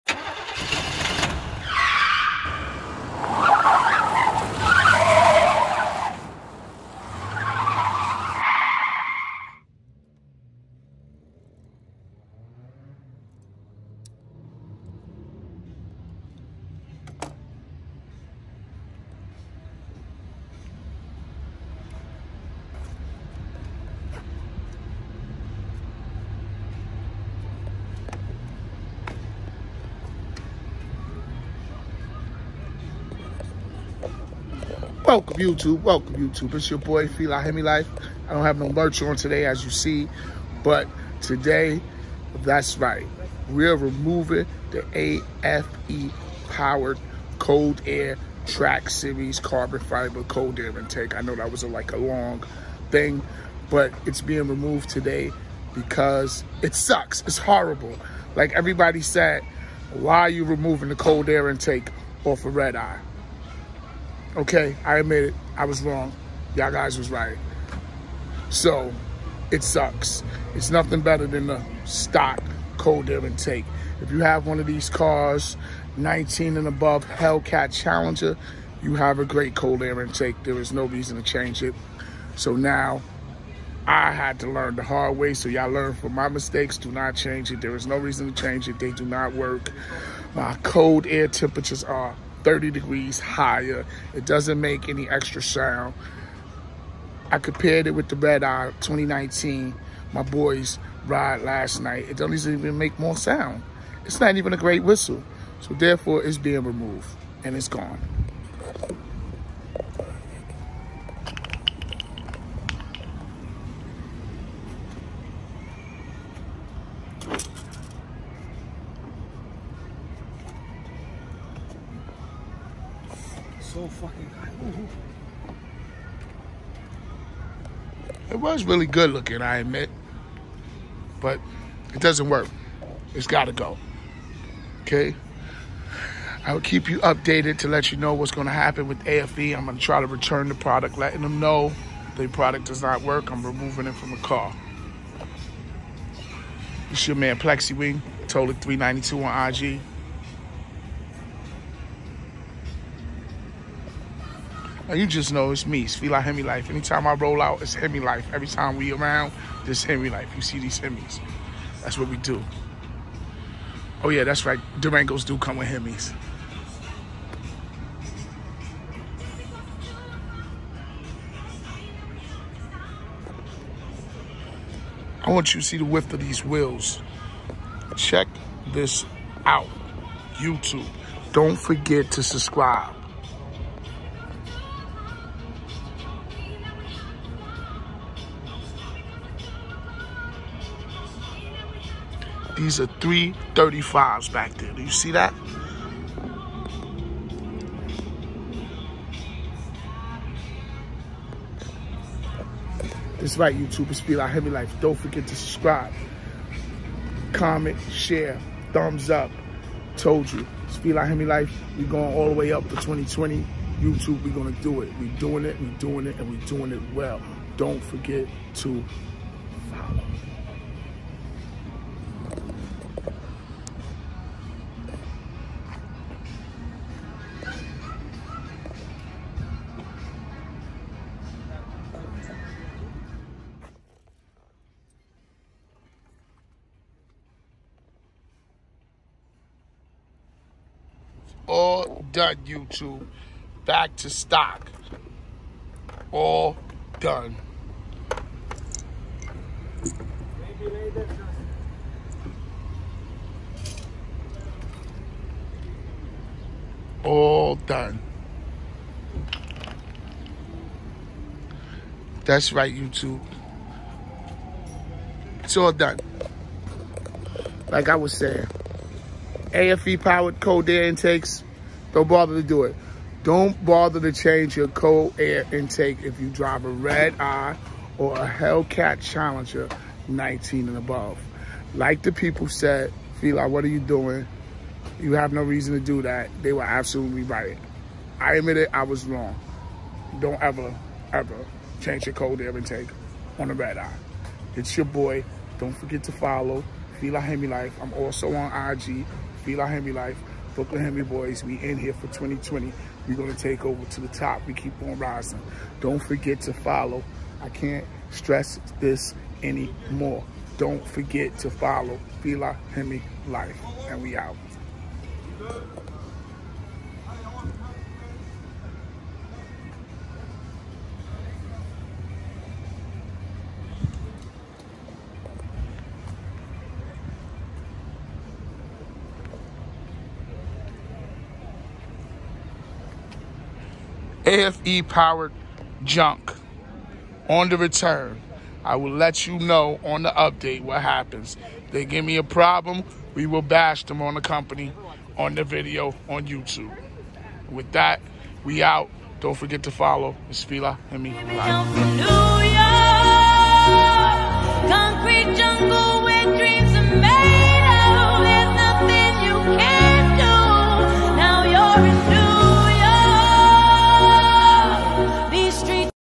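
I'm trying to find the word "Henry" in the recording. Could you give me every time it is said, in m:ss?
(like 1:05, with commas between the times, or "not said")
5:00.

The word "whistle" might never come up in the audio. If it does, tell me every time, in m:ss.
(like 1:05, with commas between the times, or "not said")
1:44.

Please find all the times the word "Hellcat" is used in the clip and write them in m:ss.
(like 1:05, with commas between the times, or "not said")
1:17, 4:38.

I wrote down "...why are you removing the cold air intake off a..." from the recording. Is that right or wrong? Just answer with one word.
right.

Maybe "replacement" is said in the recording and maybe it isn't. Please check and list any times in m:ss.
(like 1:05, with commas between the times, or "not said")
not said.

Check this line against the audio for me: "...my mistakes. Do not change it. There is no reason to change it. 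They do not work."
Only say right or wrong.
right.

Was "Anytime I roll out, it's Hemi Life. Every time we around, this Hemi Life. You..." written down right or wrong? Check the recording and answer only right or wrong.
right.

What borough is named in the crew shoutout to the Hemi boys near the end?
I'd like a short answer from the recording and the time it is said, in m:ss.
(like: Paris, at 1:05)
Brooklyn, at 5:00.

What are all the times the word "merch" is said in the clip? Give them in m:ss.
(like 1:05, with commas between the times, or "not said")
0:38.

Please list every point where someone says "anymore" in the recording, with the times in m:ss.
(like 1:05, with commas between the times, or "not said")
5:09.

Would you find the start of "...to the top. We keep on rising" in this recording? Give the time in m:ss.
5:03.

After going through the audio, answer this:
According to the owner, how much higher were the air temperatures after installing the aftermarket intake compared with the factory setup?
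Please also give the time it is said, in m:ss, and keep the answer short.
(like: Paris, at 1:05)
30 degrees, at 1:32.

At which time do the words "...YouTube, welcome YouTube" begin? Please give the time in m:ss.
0:35.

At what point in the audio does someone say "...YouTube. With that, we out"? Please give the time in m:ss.
5:46.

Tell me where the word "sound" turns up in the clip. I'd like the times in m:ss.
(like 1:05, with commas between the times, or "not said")
1:35, 1:43.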